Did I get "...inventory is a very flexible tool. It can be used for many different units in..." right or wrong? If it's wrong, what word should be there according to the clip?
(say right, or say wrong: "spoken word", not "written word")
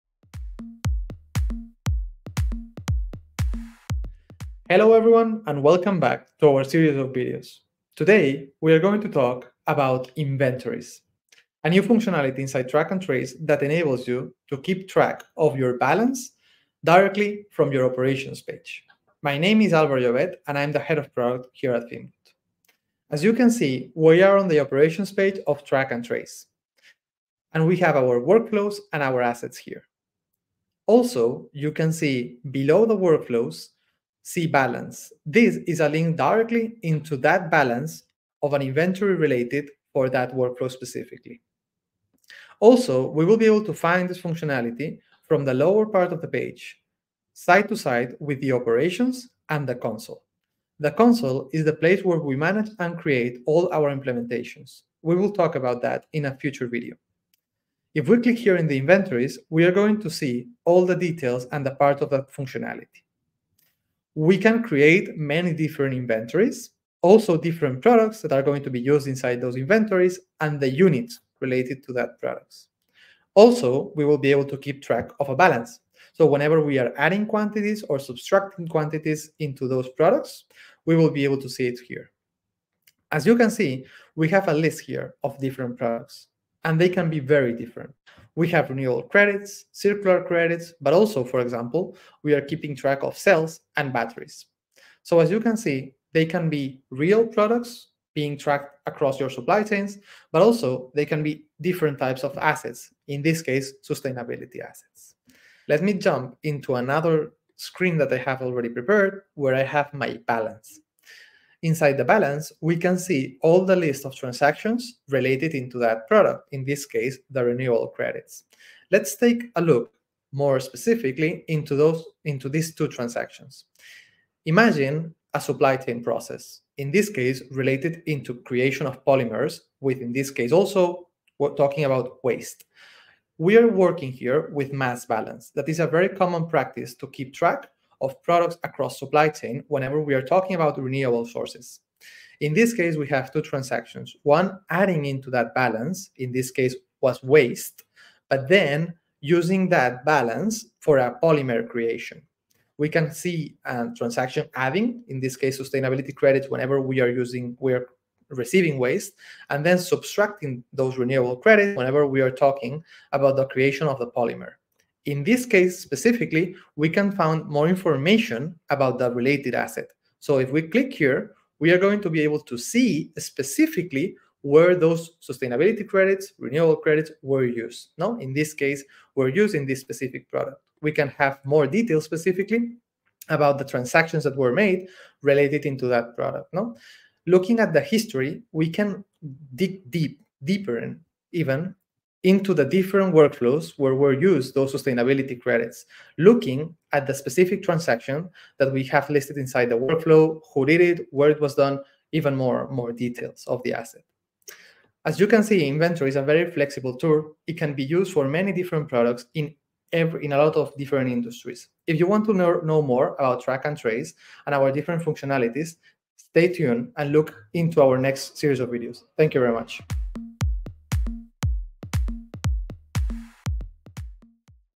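wrong: "products", not "units".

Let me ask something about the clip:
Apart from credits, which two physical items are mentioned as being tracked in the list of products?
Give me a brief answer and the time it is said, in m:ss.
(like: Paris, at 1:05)
Cells and batteries, at 1:33.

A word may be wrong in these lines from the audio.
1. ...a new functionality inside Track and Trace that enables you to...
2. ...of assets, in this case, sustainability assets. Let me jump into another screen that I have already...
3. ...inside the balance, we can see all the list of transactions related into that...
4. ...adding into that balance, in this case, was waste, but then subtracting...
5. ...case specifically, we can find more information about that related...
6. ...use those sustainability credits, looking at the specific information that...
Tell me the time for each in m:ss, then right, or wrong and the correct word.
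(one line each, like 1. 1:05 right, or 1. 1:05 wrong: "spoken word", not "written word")
1. 0:11 right
2. 1:42 right
3. 1:51 right
4. 2:24 wrong: "using", not "subtracting"
5. 2:45 right
6. 3:14 wrong: "transaction", not "information".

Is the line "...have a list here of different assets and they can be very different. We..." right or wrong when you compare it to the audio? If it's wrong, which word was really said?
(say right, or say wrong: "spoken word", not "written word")
wrong: "products", not "assets".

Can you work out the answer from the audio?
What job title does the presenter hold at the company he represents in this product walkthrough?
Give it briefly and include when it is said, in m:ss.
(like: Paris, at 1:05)
Head of product, at 0:20.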